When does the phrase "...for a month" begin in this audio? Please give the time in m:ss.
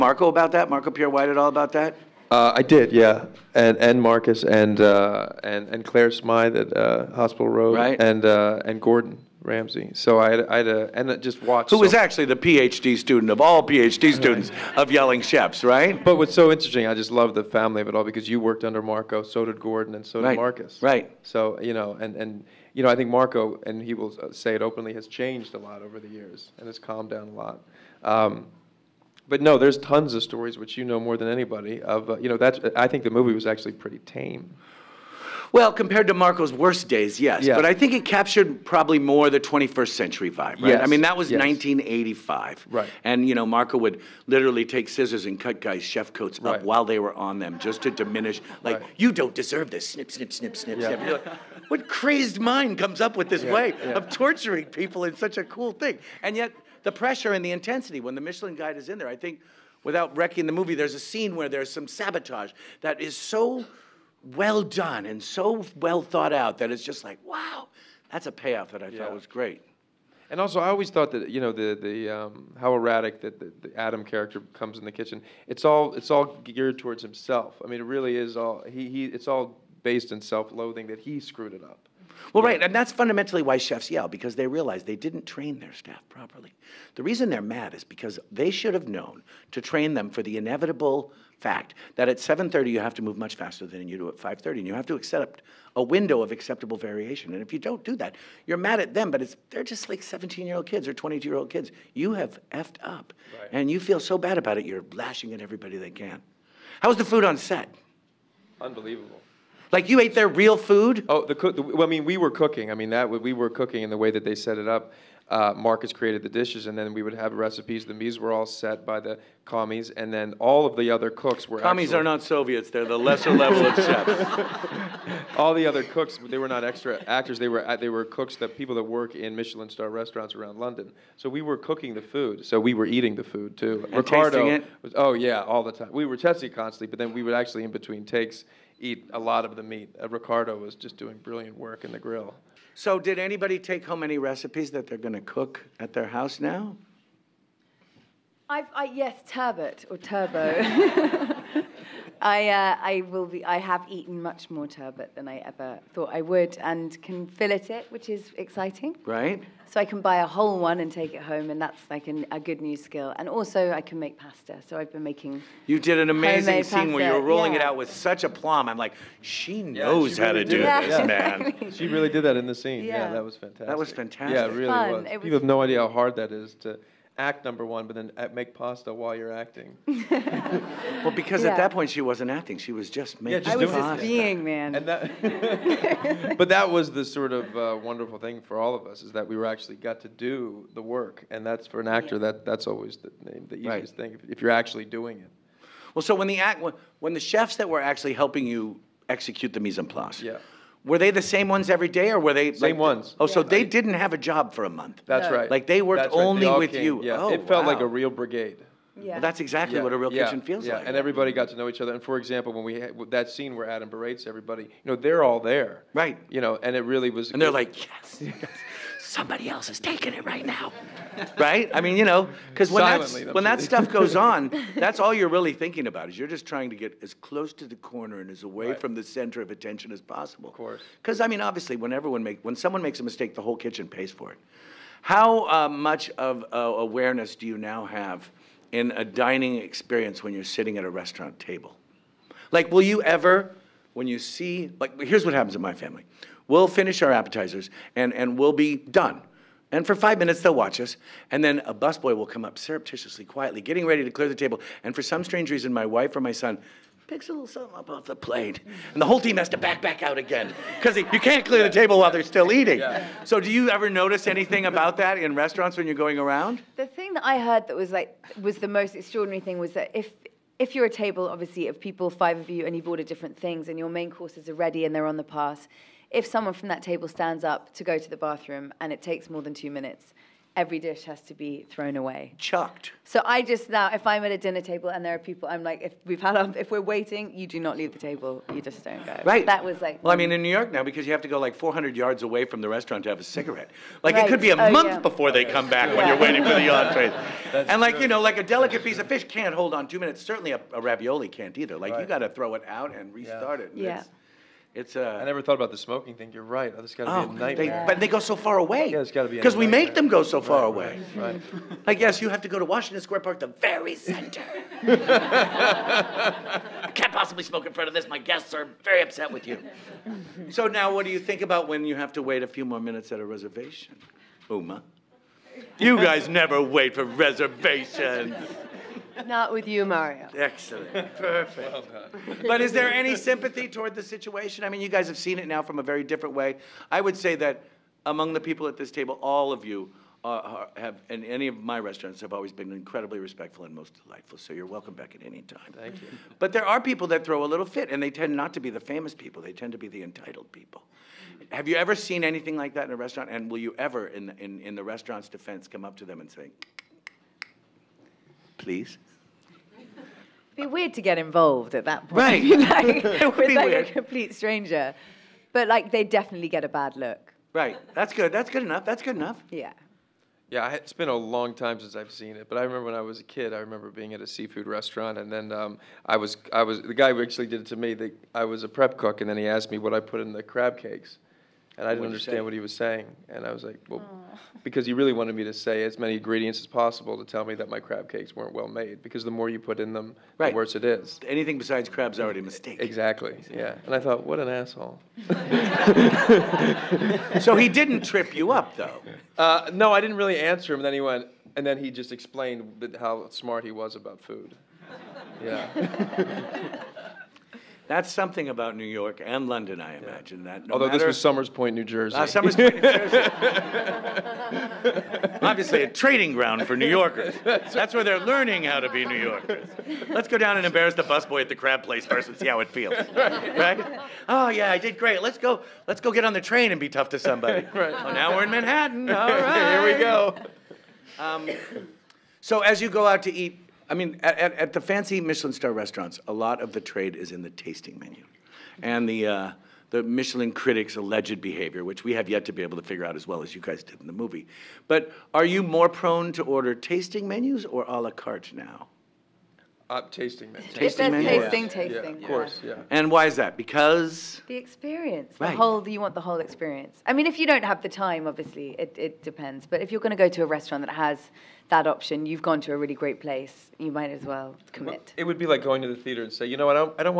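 3:24.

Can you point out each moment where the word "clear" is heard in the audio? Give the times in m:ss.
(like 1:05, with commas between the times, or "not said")
4:14, 4:21.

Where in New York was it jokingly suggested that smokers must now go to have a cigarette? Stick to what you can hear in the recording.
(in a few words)
Washington Square Park.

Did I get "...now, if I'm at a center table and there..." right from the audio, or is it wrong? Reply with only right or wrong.
wrong.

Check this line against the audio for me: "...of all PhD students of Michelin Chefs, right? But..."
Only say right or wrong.
wrong.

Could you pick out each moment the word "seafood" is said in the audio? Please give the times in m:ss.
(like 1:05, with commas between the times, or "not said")
6:14.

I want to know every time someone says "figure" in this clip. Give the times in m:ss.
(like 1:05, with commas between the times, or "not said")
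7:22.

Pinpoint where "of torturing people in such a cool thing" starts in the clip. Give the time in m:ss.
0:53.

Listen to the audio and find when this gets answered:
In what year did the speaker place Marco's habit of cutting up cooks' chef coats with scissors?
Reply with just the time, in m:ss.
0:41.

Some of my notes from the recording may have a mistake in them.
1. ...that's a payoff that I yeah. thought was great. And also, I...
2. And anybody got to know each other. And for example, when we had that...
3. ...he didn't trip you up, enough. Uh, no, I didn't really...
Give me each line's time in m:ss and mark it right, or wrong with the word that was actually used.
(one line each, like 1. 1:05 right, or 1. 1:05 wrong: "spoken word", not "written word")
1. 1:08 right
2. 3:30 wrong: "everybody", not "anybody"
3. 6:37 wrong: "though", not "enough".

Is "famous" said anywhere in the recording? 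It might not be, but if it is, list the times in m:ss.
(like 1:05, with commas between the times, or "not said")
5:48.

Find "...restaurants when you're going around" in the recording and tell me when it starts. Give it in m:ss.
4:25.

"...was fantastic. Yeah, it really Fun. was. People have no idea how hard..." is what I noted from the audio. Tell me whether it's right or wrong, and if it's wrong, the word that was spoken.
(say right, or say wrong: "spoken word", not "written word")
right.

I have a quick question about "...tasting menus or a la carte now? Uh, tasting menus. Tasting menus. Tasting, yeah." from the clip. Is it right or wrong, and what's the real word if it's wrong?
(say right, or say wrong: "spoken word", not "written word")
right.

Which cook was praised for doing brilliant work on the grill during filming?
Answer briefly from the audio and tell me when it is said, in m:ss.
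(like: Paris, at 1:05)
Ricardo, at 2:20.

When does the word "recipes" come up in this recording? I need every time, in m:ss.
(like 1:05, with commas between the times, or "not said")
1:57, 2:24.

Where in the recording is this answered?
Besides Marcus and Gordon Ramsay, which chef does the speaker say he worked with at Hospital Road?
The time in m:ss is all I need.
0:05.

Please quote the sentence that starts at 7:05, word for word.
Let's go get on the train and be tough to somebody.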